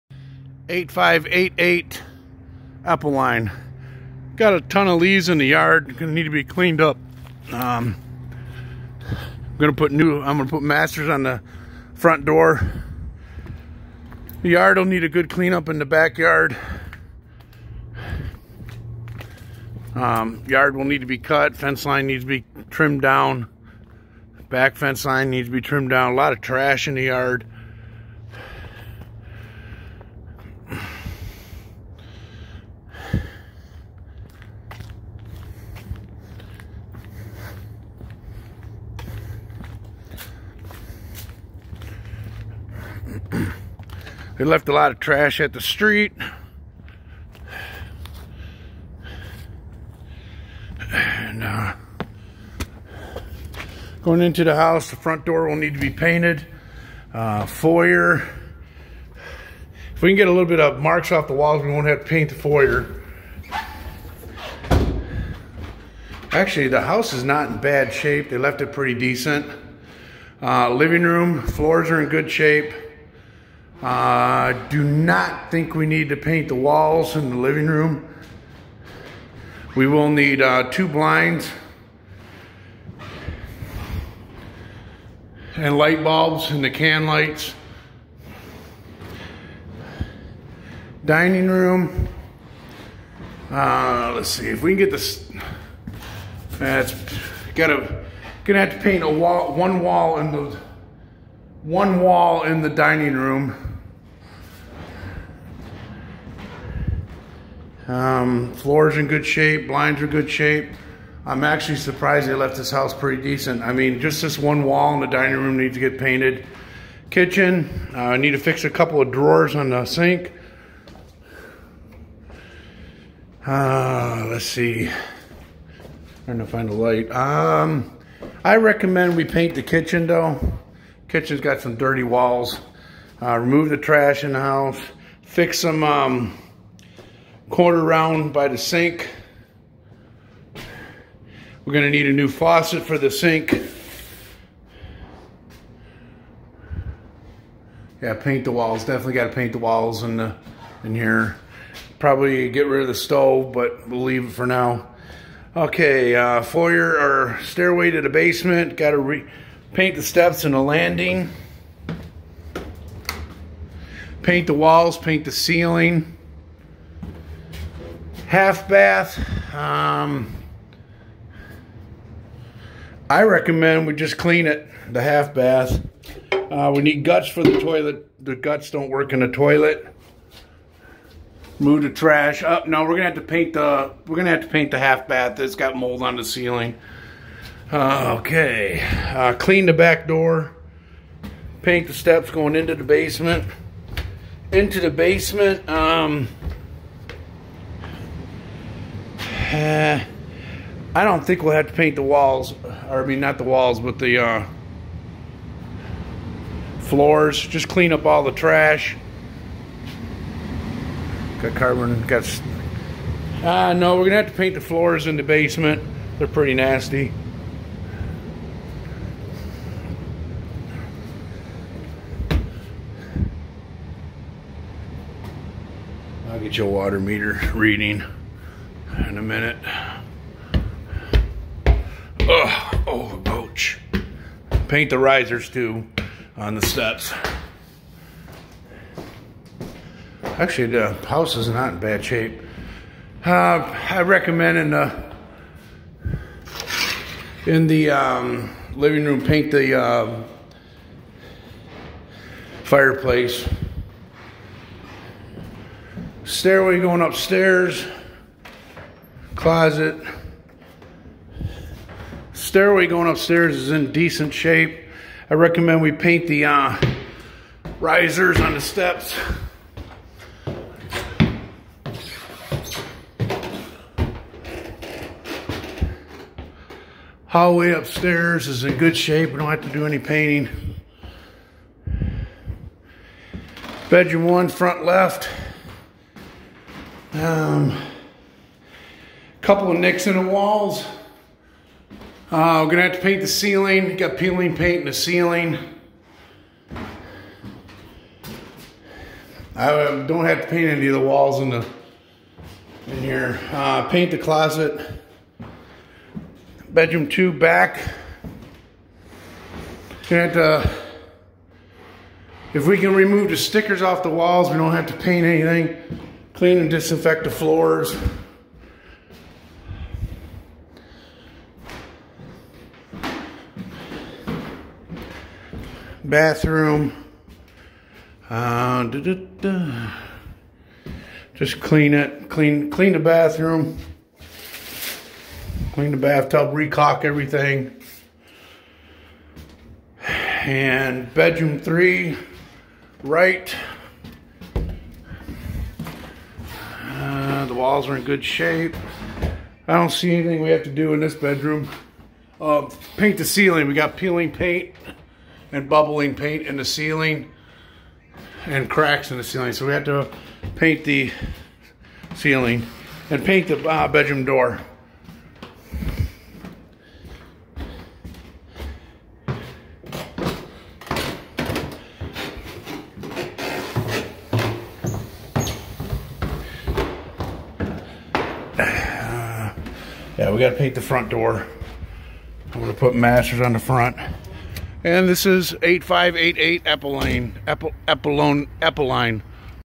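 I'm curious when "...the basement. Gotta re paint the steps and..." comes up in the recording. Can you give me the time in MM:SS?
02:38.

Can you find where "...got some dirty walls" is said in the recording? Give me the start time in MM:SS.
02:11.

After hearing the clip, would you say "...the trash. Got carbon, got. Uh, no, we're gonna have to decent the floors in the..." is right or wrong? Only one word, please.
wrong.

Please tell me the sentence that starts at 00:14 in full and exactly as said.
The yard will need a good cleanup in the backyard.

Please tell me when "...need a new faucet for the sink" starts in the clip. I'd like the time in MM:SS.
02:21.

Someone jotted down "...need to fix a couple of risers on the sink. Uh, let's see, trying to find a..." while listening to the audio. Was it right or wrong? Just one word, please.
wrong.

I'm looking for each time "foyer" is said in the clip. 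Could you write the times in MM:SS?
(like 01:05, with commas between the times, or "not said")
00:57, 01:02, 02:36.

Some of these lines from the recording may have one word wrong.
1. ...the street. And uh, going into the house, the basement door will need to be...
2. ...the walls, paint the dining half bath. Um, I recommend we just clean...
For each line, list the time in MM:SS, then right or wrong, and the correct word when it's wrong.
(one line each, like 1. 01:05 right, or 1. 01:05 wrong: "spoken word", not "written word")
1. 00:45 wrong: "front", not "basement"
2. 02:44 wrong: "ceiling", not "dining".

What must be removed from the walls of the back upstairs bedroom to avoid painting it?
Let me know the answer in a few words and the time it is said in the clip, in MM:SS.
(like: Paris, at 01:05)
Stickers, at 05:13.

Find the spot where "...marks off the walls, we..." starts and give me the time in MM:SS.
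01:00.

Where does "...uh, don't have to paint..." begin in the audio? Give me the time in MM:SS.
04:59.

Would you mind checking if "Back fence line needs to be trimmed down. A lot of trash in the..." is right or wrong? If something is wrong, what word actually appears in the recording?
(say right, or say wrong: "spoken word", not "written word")
right.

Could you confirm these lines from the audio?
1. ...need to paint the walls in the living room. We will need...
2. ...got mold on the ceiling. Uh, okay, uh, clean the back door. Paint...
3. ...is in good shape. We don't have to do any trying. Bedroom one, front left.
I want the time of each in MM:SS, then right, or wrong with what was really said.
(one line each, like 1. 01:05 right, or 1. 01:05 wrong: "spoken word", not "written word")
1. 01:15 right
2. 03:05 right
3. 04:38 wrong: "painting", not "trying".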